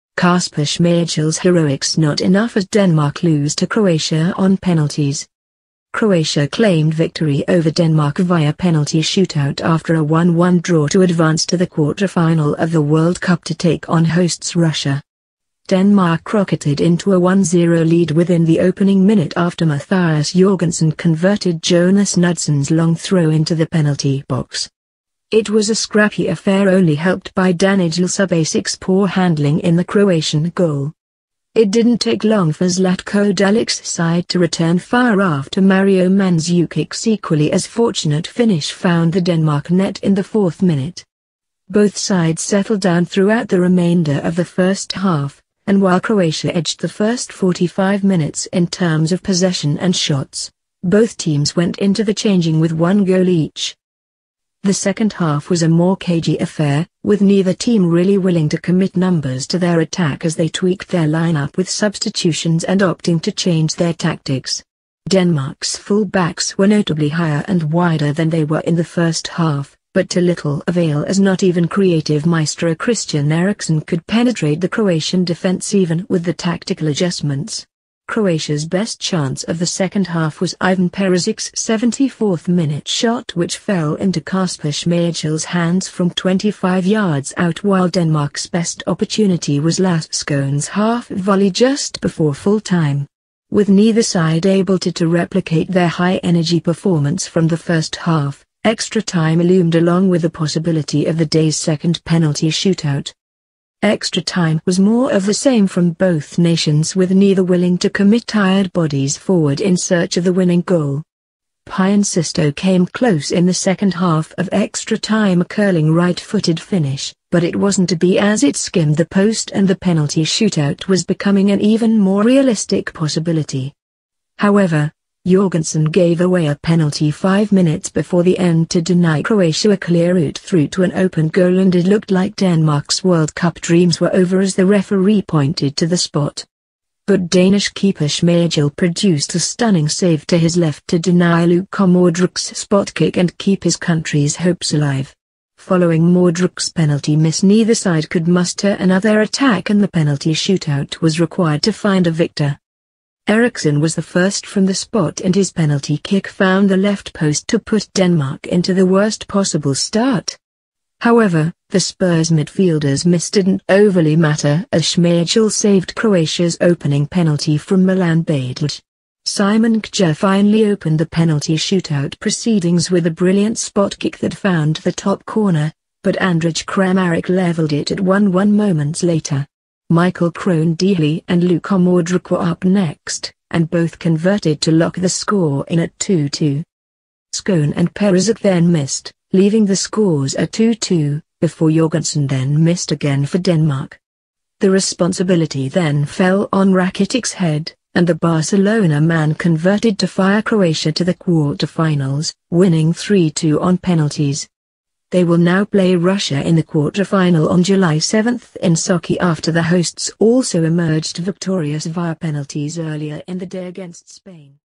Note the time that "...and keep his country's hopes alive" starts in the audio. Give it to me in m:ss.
2:23.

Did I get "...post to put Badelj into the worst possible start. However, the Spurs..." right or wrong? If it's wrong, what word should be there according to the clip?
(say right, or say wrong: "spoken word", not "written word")
wrong: "Denmark", not "Badelj".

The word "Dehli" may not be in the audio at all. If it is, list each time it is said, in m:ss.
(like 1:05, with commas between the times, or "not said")
3:00.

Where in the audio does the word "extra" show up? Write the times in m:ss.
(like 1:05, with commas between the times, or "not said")
1:38, 1:43, 1:54.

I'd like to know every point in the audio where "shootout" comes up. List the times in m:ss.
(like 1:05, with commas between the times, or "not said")
0:09, 1:42, 2:00, 2:30, 2:51.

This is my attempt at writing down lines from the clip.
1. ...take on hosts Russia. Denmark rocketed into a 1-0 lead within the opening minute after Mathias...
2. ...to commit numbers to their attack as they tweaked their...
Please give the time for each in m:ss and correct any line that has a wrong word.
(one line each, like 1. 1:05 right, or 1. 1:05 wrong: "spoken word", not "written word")
1. 0:13 right
2. 0:58 right.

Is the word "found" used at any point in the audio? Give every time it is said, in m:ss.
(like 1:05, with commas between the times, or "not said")
0:38, 2:36, 2:54.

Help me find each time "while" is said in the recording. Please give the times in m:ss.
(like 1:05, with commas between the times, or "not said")
0:45, 1:27.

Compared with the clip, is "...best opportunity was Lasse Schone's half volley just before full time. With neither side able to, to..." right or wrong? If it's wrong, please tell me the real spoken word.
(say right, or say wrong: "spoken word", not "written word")
right.